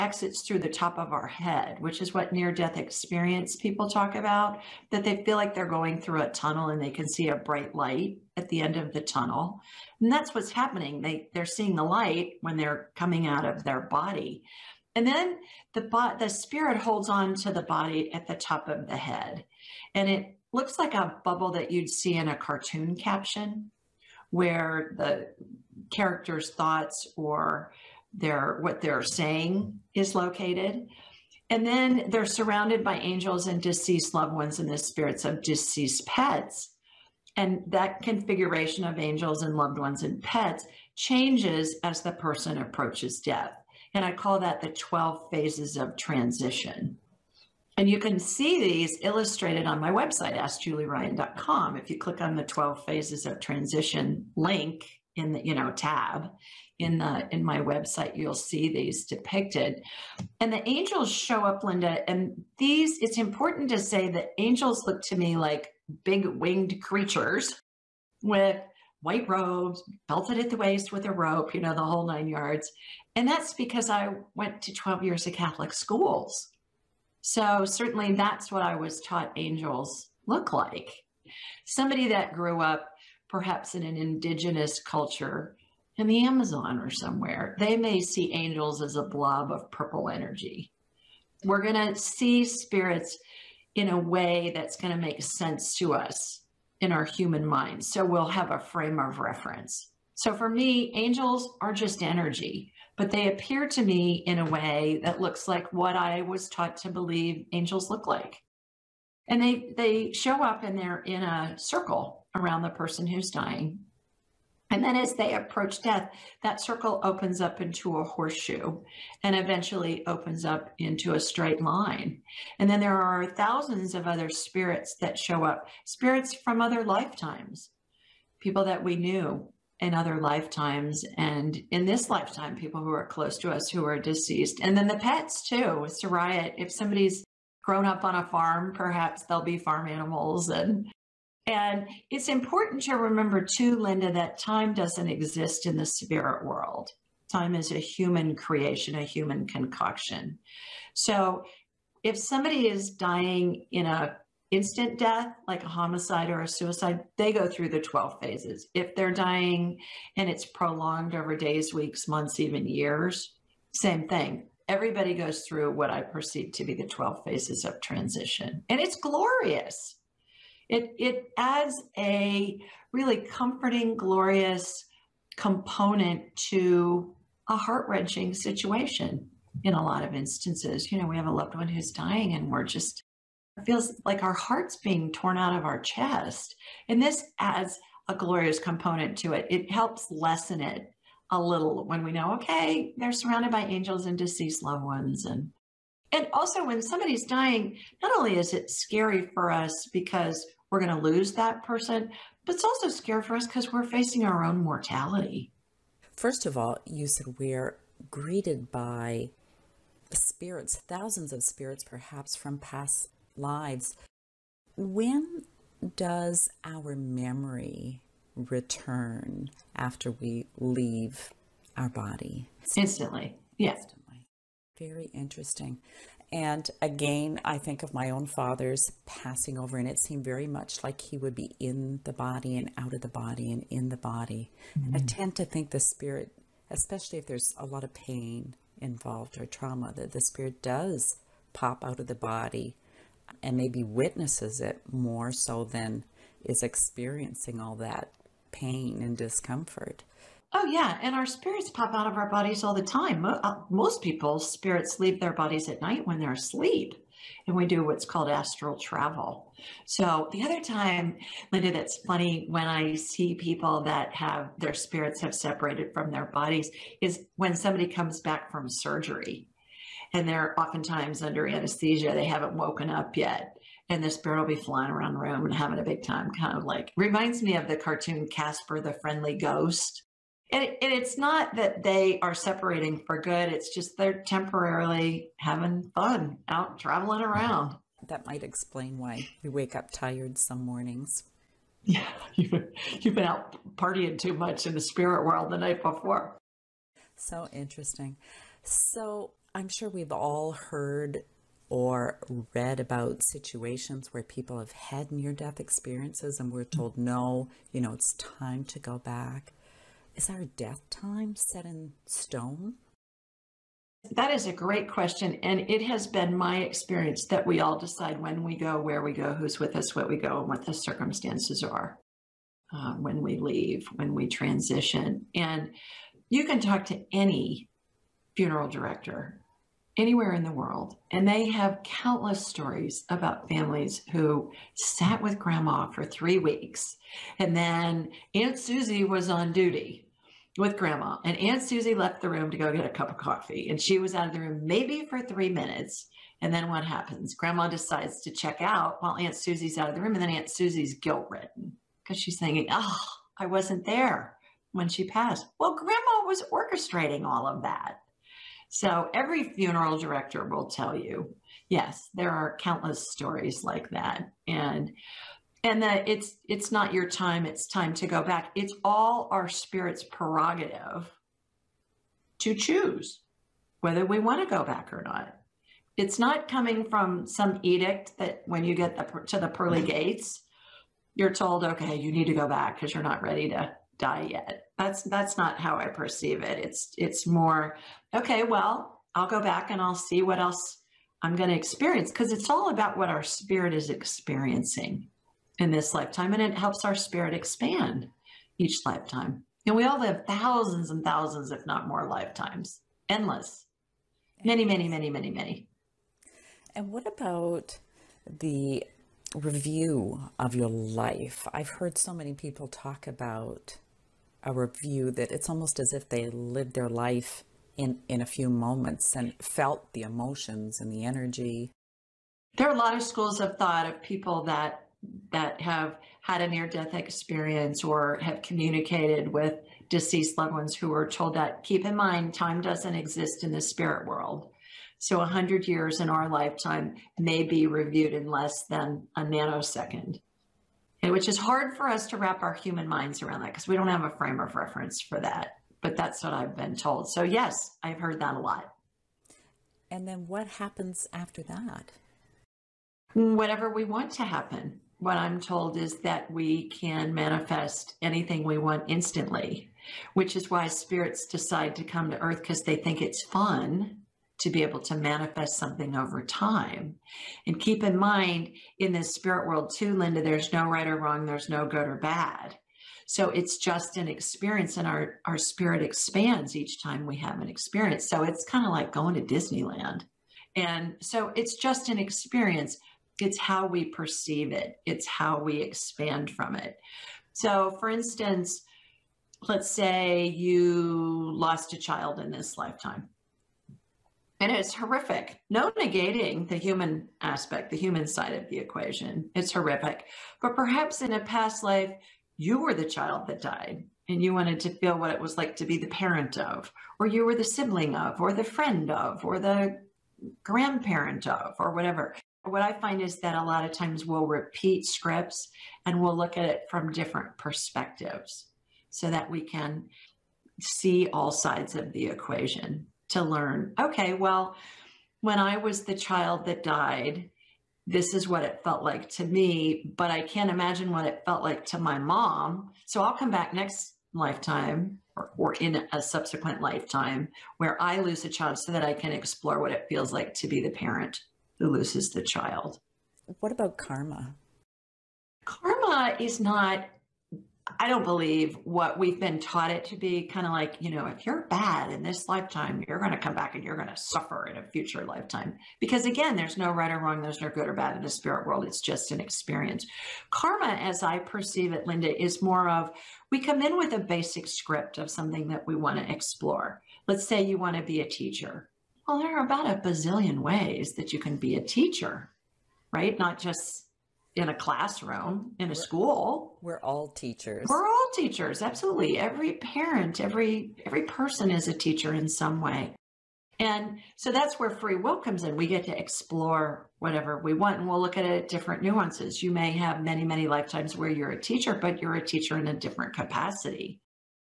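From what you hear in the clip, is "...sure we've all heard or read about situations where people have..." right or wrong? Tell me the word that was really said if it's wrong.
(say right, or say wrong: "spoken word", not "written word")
right.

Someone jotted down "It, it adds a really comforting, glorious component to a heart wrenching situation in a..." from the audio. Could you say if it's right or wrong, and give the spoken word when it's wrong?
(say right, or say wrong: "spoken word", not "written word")
right.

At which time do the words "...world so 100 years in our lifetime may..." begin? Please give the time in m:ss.
7:14.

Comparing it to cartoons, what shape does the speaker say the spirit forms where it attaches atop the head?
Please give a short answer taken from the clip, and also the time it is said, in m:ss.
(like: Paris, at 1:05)
A bubble, at 0:20.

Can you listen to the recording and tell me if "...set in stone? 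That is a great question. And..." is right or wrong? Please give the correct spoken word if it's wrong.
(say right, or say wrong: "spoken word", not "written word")
right.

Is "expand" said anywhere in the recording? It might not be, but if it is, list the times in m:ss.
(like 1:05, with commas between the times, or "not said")
6:37, 7:55, 8:05.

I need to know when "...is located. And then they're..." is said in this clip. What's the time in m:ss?
0:29.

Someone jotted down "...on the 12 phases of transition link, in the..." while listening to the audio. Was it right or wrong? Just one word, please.
right.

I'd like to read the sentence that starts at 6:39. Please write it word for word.
And we all live thousands and thousands, if not more, lifetimes, endless, many, many, many, many, many.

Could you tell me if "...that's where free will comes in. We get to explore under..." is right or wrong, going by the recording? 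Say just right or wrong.
wrong.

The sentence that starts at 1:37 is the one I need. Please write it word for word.
So we'll have a frame of reference.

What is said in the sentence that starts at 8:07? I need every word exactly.
So, for instance, let's say you lost a child in this lifetime.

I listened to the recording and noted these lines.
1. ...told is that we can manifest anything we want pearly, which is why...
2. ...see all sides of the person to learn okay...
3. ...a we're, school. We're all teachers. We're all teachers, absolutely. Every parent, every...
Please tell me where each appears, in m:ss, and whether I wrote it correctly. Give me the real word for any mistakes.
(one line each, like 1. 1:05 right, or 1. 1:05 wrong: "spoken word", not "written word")
1. 7:35 wrong: "instantly", not "pearly"
2. 8:40 wrong: "equation", not "person"
3. 9:35 right.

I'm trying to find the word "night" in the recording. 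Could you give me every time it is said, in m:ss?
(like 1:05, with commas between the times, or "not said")
4:15, 4:55.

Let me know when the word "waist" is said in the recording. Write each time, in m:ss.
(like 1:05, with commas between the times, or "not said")
1:10.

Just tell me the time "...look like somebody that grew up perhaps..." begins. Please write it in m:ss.
1:20.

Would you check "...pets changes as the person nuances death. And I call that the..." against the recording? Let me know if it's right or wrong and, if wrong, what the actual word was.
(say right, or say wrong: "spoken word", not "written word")
wrong: "approaches", not "nuances".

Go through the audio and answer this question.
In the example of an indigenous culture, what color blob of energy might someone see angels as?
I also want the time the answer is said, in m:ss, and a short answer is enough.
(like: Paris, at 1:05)
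Purple, at 1:29.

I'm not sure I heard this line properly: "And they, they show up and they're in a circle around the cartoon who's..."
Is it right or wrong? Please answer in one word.
wrong.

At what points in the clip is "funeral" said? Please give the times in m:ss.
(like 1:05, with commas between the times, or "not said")
5:28, 5:59.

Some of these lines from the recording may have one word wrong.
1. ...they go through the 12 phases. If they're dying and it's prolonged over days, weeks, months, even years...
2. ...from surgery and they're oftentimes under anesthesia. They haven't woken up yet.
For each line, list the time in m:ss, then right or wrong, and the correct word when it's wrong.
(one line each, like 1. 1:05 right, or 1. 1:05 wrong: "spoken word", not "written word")
1. 2:37 right
2. 4:28 right.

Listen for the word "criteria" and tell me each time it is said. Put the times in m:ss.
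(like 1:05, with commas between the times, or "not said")
not said.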